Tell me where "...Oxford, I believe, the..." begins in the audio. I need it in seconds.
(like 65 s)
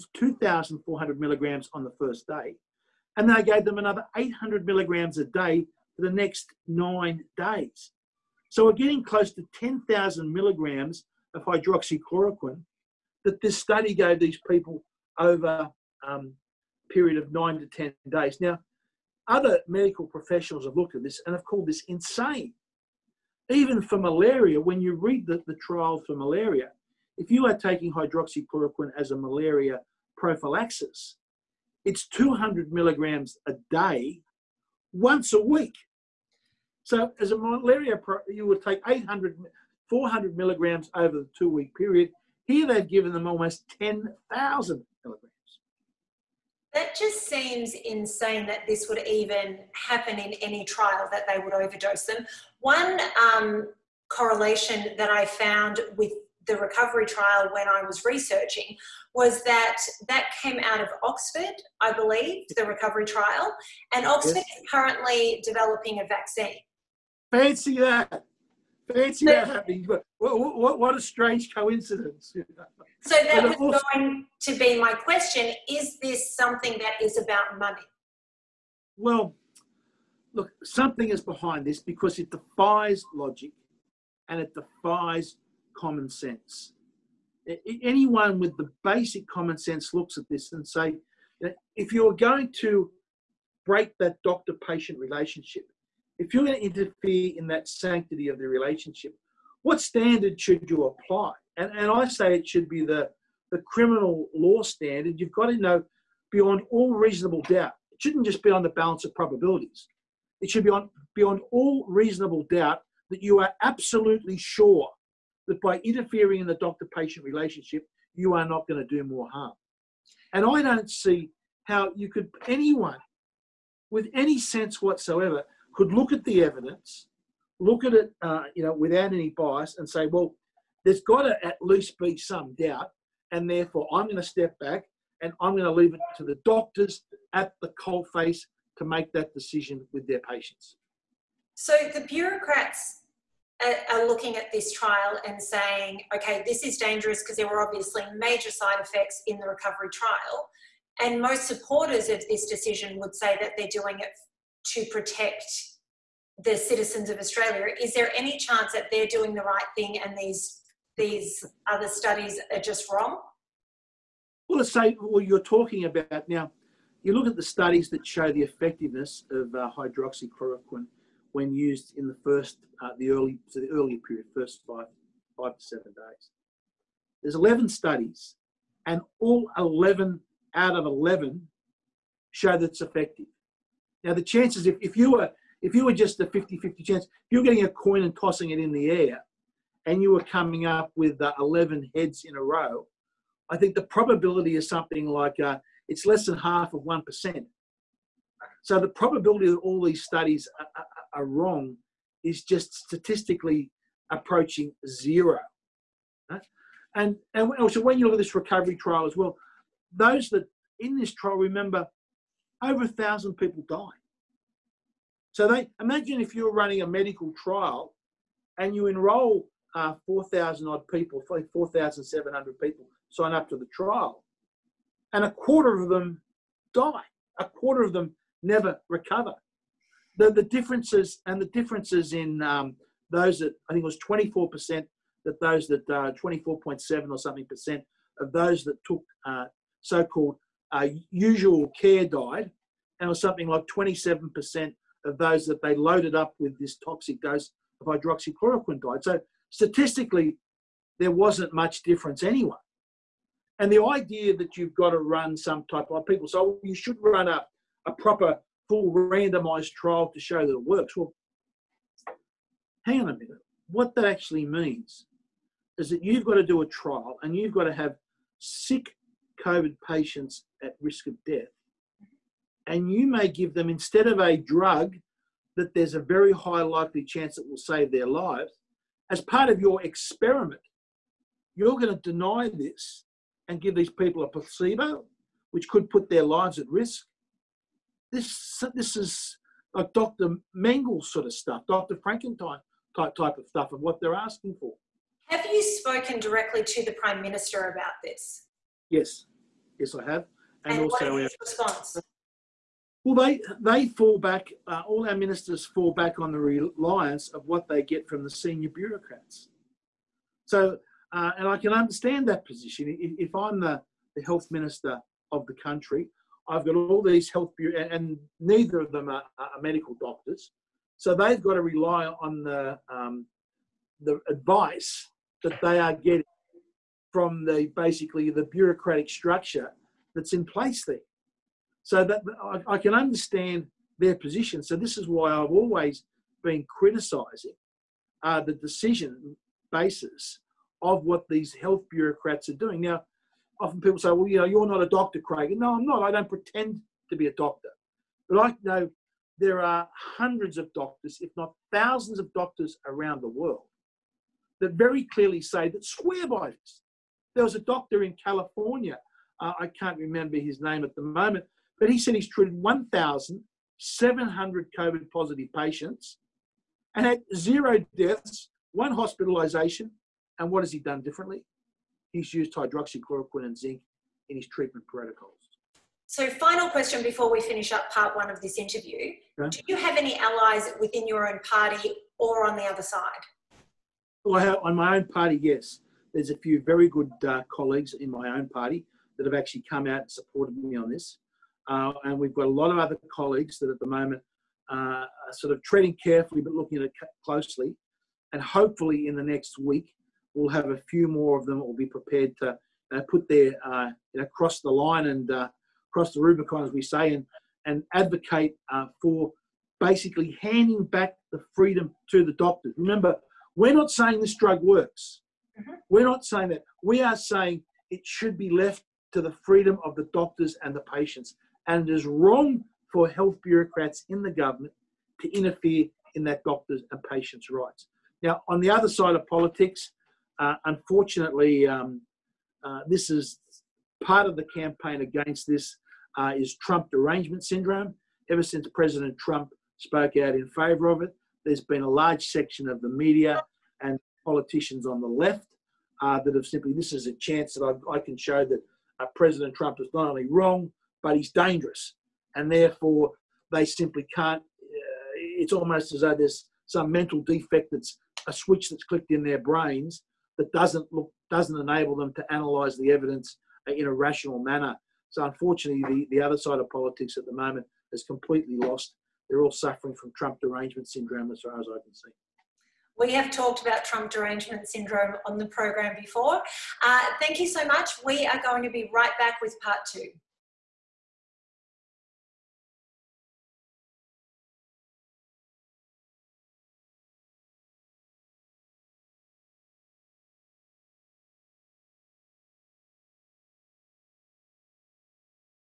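61 s.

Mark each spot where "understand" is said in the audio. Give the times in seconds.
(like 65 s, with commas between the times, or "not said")
311 s, 332 s.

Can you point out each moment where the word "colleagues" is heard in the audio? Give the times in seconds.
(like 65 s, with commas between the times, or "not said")
387 s, 393 s.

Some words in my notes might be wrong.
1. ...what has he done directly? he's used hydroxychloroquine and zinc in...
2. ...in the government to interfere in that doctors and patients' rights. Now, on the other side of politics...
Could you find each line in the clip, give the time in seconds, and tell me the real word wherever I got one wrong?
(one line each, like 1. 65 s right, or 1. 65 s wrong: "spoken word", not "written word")
1. 370 s wrong: "differently", not "directly"
2. 424 s right.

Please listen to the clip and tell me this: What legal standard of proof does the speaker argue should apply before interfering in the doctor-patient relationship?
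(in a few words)
criminal law standard.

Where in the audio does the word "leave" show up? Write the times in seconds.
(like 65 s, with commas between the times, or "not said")
135 s.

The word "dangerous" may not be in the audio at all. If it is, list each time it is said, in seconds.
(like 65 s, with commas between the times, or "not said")
146 s, 451 s.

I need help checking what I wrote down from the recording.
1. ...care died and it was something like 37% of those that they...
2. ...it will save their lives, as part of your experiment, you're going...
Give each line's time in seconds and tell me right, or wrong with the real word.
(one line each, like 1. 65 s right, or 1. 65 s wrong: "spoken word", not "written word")
1. 241 s wrong: "27", not "37"
2. 277 s right.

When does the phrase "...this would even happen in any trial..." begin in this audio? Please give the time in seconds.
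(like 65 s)
48 s.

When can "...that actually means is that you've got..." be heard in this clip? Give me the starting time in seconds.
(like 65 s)
263 s.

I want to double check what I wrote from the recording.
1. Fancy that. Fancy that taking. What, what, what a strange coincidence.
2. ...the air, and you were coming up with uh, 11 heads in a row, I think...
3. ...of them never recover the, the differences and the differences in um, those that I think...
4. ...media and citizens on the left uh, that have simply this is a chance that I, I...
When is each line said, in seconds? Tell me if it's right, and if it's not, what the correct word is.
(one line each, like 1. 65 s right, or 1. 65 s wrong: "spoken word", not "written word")
1. 67 s wrong: "happening", not "taking"
2. 188 s right
3. 227 s right
4. 442 s wrong: "politicians", not "citizens".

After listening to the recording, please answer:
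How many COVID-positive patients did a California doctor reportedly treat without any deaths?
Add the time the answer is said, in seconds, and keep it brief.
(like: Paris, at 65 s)
1,700, at 362 s.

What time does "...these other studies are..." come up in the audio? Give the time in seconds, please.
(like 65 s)
160 s.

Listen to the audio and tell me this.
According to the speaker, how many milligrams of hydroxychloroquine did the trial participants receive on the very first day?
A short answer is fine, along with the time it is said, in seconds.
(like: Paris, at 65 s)
2,400 milligrams, at 0 s.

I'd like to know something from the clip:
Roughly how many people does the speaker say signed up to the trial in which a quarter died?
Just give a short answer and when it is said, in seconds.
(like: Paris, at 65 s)
4,700, at 221 s.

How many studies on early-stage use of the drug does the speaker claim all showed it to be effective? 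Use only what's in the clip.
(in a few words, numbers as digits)
11.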